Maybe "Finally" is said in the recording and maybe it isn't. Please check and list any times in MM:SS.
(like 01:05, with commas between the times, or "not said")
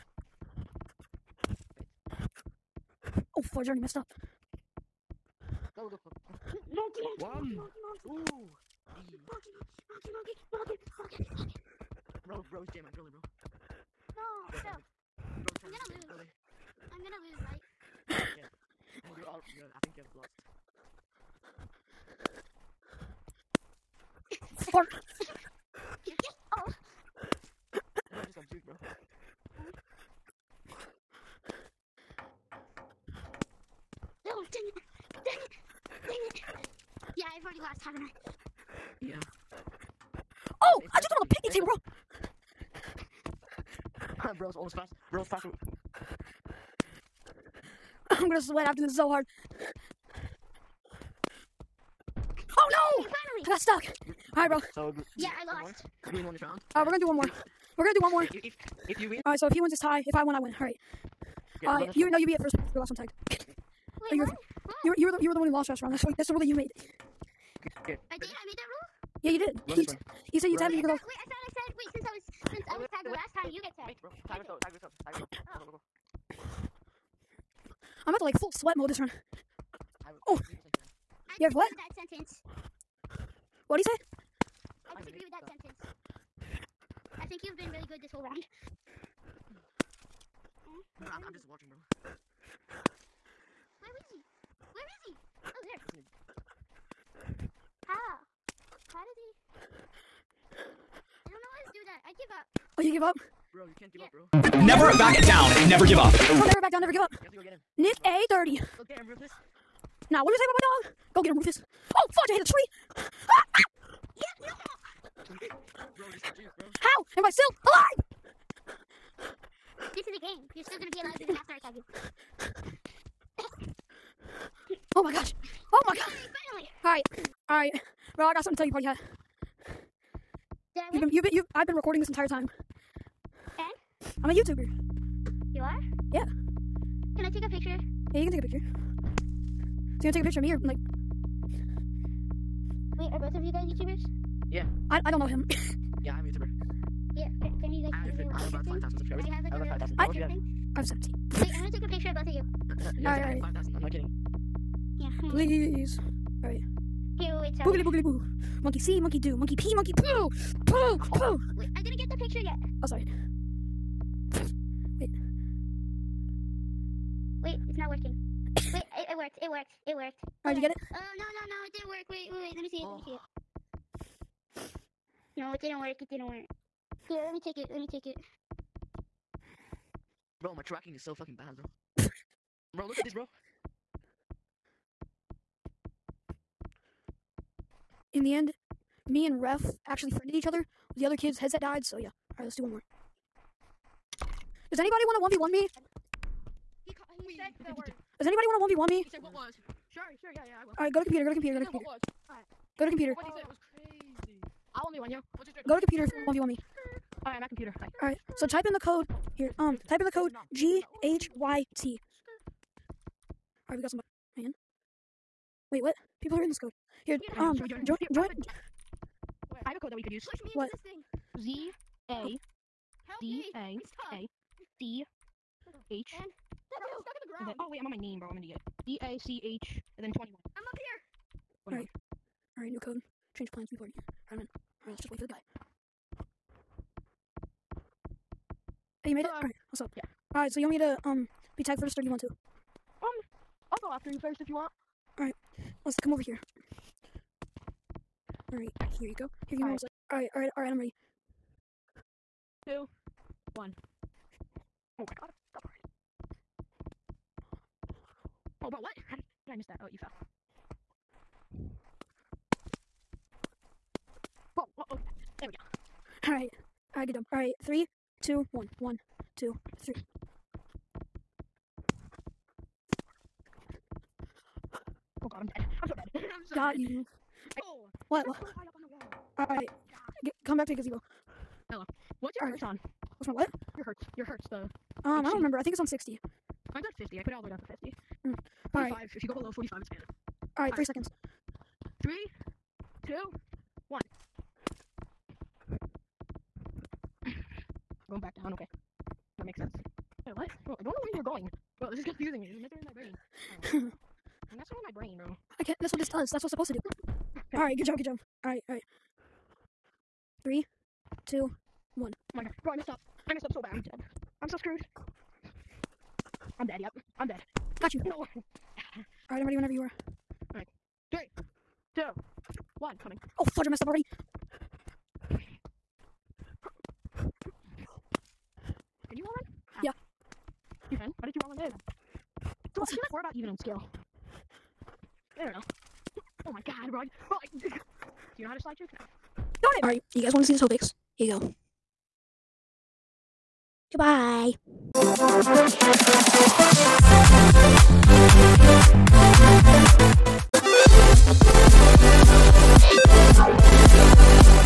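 00:53, 02:06.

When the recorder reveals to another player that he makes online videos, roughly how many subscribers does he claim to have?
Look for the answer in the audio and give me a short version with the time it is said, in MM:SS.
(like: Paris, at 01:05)
5,000, at 02:27.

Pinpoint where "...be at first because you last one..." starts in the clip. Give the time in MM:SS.
01:02.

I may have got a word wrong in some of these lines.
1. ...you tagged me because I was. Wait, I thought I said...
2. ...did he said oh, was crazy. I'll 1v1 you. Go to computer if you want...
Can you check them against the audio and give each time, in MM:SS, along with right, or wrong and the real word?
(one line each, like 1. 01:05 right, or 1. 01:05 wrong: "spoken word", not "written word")
1. 01:10 right
2. 03:23 right.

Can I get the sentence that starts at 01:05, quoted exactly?
That's what, that's the rule that you made.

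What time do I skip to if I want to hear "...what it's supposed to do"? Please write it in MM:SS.
05:06.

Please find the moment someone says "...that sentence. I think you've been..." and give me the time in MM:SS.
01:25.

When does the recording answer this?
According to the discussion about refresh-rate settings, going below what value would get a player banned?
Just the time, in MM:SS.
04:49.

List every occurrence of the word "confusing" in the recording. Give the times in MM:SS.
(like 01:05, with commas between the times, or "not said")
05:02.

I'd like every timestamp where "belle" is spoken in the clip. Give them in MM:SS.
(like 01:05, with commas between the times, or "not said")
not said.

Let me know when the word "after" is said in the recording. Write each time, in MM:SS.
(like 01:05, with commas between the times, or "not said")
00:48, 02:01, 04:03.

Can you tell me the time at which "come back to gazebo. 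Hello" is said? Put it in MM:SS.
04:40.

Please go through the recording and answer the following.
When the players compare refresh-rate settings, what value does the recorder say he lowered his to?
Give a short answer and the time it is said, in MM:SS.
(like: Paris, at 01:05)
50, at 04:46.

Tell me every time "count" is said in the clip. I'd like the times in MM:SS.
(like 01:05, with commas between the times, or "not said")
not said.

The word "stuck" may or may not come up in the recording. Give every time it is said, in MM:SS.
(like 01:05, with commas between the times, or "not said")
00:53, 03:47.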